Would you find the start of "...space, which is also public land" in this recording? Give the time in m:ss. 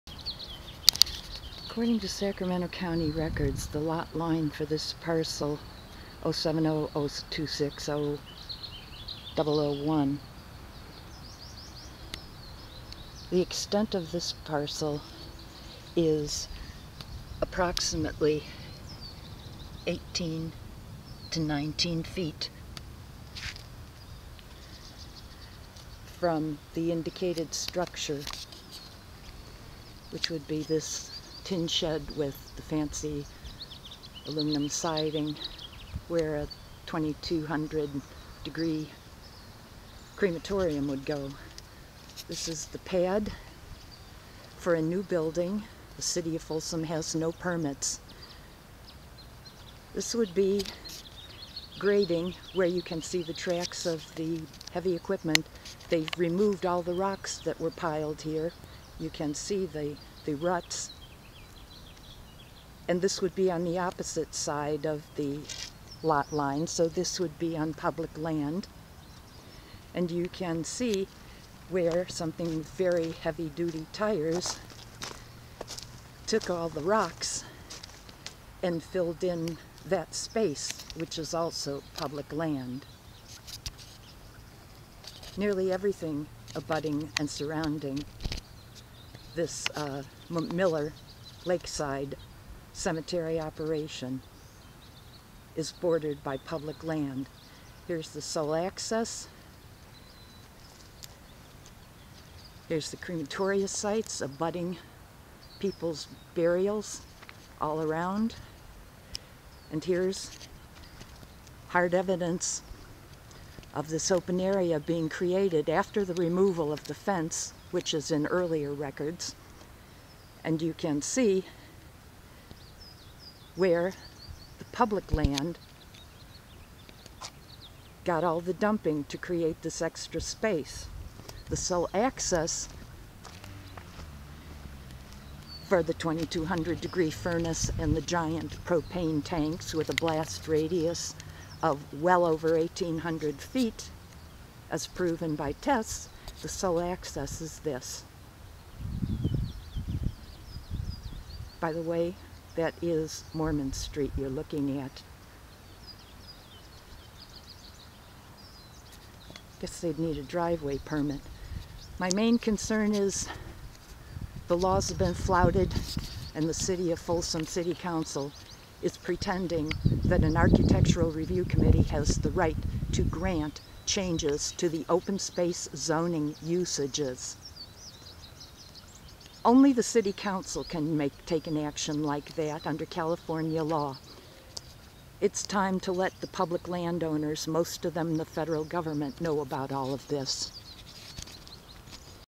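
1:20.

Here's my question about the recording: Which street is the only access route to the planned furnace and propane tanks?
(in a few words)
Mormon Street.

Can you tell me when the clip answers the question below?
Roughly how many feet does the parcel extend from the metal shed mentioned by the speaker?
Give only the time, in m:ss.
0:19.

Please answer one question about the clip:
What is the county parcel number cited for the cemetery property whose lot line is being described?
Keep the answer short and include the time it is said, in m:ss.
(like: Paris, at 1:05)
07002600001, at 0:06.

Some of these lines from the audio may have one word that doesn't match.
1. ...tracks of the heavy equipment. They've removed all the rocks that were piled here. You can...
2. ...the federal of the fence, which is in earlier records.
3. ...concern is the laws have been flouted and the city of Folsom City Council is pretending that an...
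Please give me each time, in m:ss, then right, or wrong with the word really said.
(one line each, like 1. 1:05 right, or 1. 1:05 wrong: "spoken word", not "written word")
1. 0:53 right
2. 1:56 wrong: "removal", not "federal"
3. 2:42 right.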